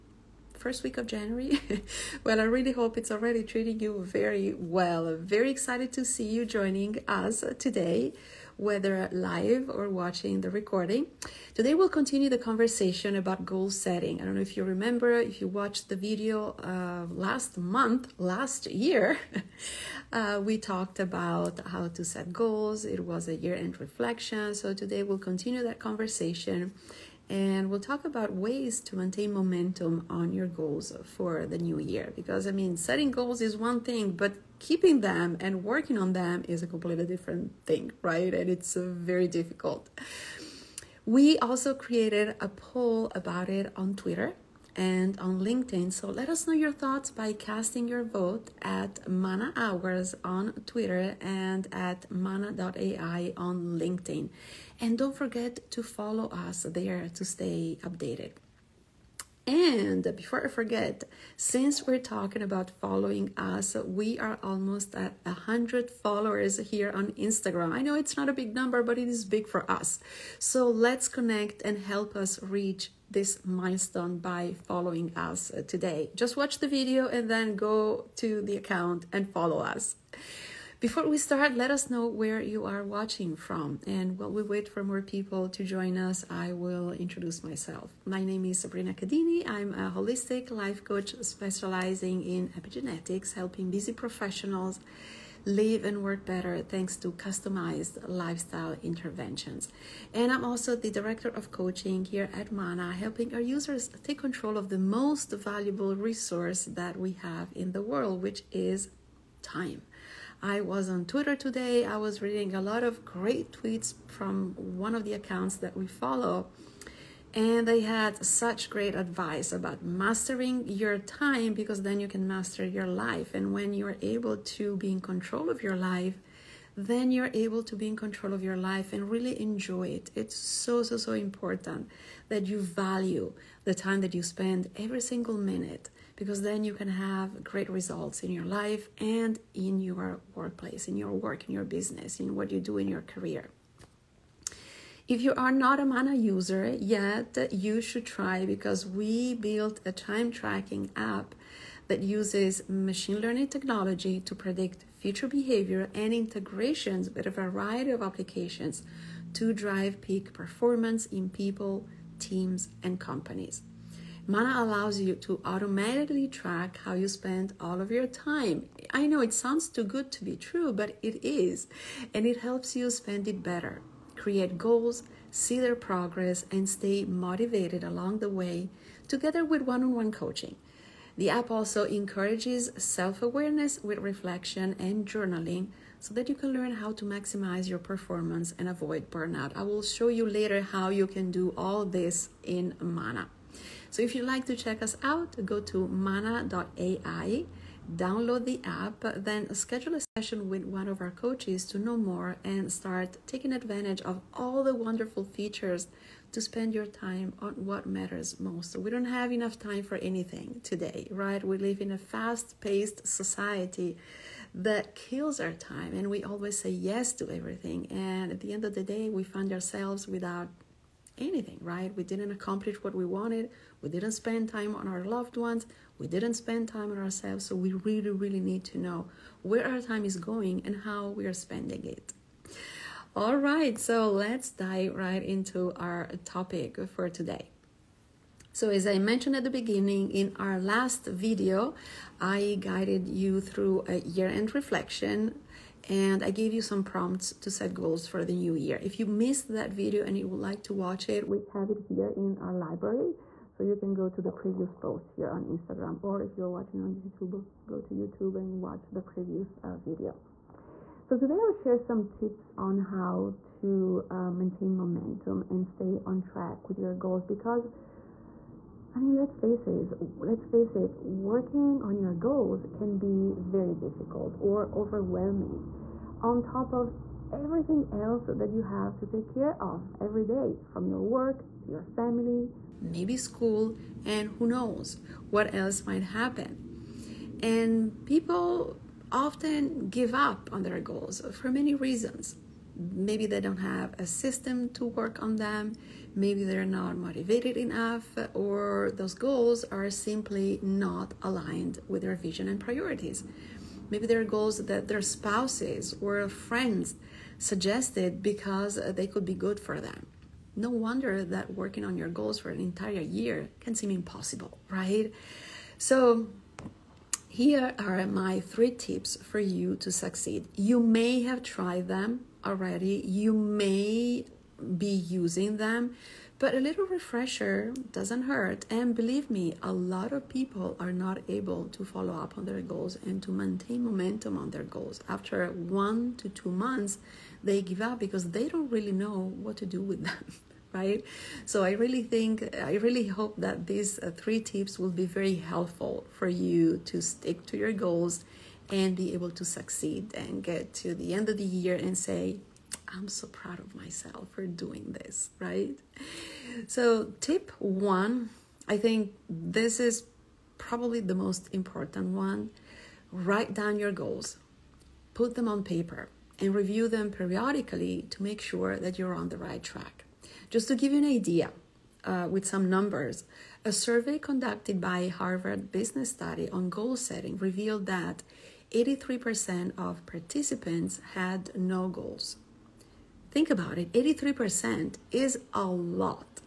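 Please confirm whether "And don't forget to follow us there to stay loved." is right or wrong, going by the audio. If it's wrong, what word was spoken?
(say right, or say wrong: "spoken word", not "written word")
wrong: "updated", not "loved".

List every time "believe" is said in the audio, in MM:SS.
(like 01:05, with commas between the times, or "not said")
05:28.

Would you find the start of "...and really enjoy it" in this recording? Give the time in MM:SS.
02:08.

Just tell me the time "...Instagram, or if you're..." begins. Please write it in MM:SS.
04:15.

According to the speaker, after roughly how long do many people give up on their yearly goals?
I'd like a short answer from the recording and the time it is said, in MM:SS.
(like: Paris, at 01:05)
1 to 2 months, at 05:35.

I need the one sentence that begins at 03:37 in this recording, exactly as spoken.
And at the end of the day, we find ourselves without anything, right?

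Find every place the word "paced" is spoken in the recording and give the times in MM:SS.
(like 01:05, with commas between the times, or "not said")
03:32.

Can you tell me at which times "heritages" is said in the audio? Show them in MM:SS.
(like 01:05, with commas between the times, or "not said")
not said.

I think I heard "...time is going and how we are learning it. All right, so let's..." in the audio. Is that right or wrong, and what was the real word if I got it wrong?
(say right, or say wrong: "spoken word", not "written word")
wrong: "spending", not "learning".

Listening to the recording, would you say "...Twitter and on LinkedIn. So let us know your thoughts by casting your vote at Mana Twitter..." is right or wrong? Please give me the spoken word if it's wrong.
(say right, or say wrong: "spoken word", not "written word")
wrong: "Hours", not "Twitter".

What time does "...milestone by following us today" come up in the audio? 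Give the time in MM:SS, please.
01:13.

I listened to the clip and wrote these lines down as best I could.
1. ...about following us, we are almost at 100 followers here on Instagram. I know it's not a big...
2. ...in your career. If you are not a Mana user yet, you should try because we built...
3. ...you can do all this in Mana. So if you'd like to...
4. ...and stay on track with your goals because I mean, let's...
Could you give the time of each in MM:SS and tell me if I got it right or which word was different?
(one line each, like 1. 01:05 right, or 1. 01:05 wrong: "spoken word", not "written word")
1. 01:02 right
2. 02:22 right
3. 03:10 right
4. 04:25 right.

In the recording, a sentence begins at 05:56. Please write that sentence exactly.
So, tip one, I think this is probably the most important one.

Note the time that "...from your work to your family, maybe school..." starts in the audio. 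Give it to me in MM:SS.
04:40.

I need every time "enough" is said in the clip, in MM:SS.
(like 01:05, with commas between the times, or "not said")
03:29, 04:57.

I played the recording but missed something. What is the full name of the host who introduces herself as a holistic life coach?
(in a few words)
Sabrina Cadini.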